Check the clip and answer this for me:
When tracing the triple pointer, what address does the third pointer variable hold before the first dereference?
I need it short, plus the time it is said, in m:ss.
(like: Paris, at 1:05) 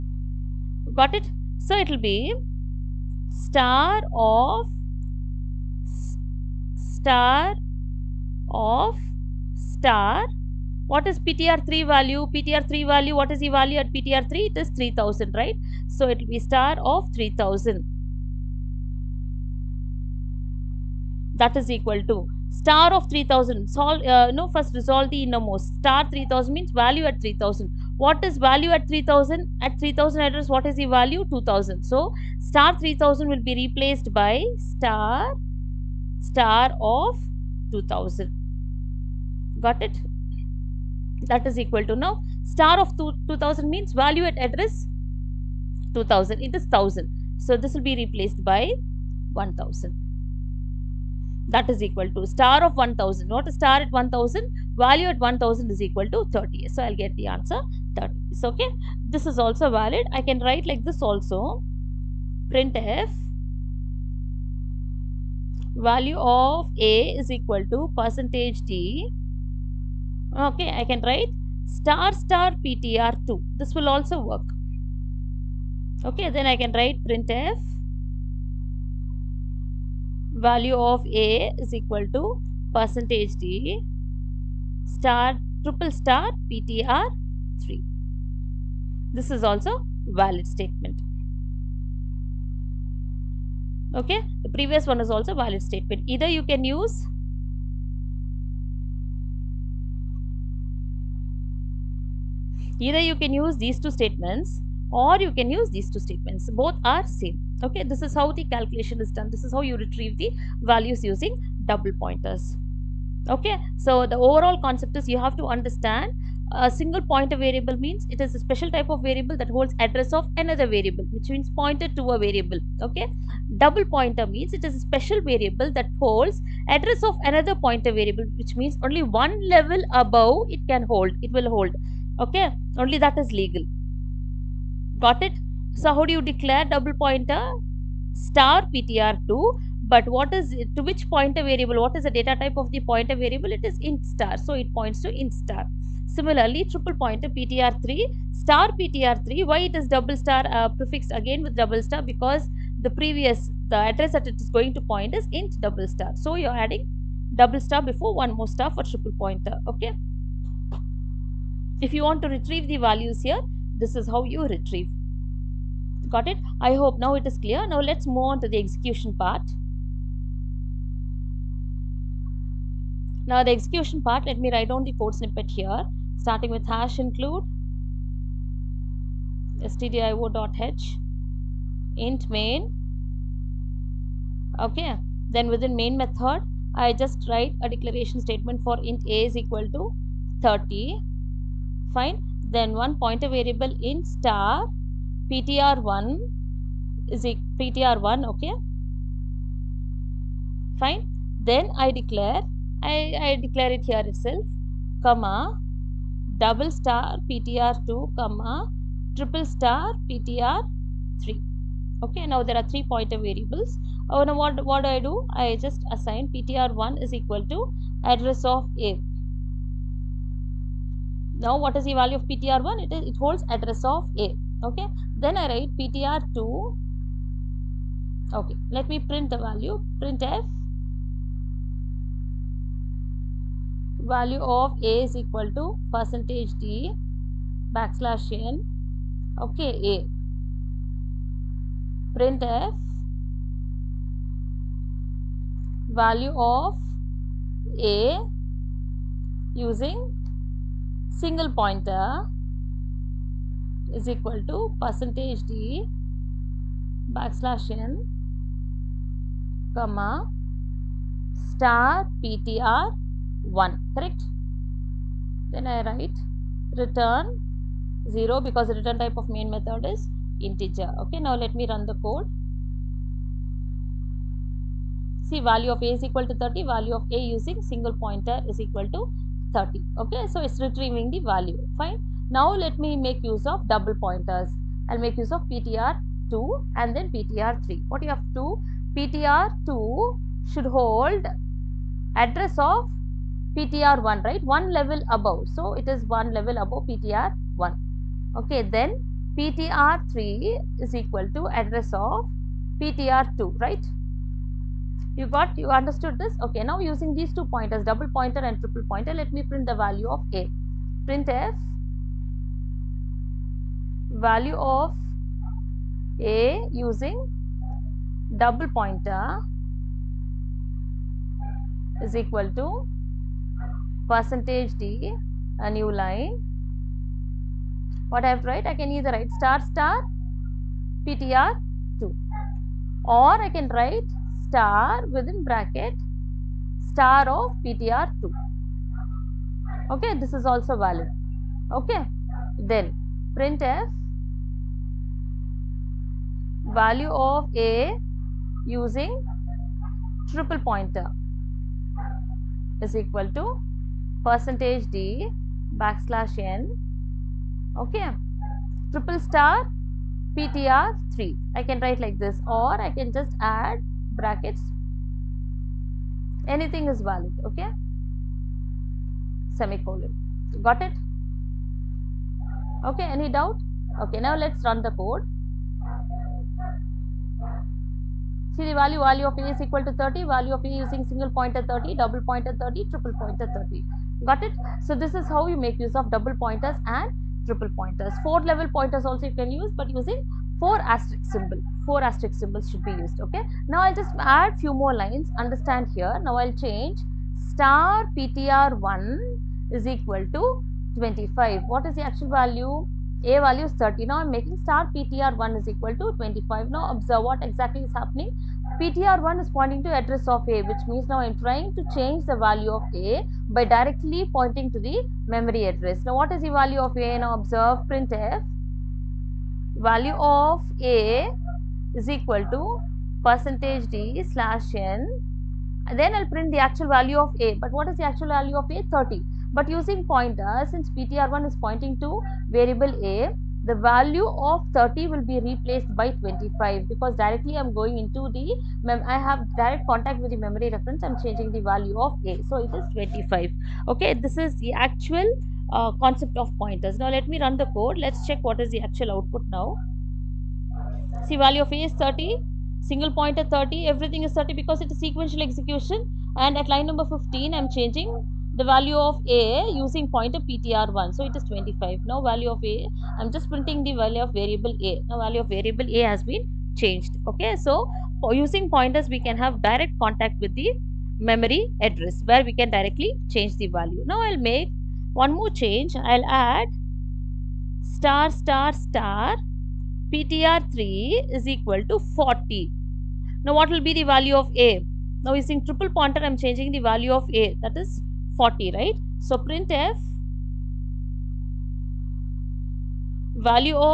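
3000, at 0:14.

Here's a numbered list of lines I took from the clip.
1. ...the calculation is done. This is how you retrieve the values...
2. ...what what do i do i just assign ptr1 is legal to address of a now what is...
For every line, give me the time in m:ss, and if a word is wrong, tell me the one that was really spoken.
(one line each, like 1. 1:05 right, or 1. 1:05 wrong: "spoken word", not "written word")
1. 1:48 right
2. 3:34 wrong: "equal", not "legal".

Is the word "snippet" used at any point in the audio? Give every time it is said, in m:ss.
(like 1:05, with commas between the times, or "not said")
2:55.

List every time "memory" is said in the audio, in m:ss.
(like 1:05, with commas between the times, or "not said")
6:55, 7:20, 7:51.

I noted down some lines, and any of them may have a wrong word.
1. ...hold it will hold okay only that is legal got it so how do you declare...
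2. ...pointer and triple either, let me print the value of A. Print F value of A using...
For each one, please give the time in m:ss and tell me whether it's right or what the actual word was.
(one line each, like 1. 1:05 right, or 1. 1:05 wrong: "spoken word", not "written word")
1. 2:10 right
2. 5:08 wrong: "pointer", not "either".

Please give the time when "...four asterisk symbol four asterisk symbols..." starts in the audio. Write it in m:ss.
6:30.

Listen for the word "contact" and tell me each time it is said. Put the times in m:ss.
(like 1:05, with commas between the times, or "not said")
7:19, 7:50.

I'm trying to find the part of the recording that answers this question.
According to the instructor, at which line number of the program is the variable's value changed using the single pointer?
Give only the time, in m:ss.
7:36.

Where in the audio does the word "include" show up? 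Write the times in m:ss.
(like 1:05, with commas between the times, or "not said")
2:56.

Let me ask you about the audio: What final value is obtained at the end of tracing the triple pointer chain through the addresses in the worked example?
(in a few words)
30.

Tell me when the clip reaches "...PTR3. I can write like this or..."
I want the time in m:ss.
6:00.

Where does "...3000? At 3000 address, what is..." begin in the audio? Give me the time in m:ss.
0:28.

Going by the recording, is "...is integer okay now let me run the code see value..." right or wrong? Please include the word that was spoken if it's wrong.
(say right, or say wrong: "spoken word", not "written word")
right.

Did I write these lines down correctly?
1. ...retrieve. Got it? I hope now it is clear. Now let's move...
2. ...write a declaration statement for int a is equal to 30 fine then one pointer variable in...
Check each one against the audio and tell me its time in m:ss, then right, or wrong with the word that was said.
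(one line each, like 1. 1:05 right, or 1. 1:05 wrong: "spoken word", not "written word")
1. 2:44 right
2. 3:07 right.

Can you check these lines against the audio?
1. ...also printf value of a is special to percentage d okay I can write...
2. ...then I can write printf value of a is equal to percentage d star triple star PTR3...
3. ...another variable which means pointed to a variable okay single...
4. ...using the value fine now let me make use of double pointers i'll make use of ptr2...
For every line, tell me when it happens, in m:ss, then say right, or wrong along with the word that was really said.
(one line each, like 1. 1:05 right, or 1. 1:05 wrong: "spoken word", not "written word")
1. 1:01 wrong: "equal", not "special"
2. 1:16 right
3. 2:00 wrong: "double", not "single"
4. 4:40 wrong: "retrieving", not "using".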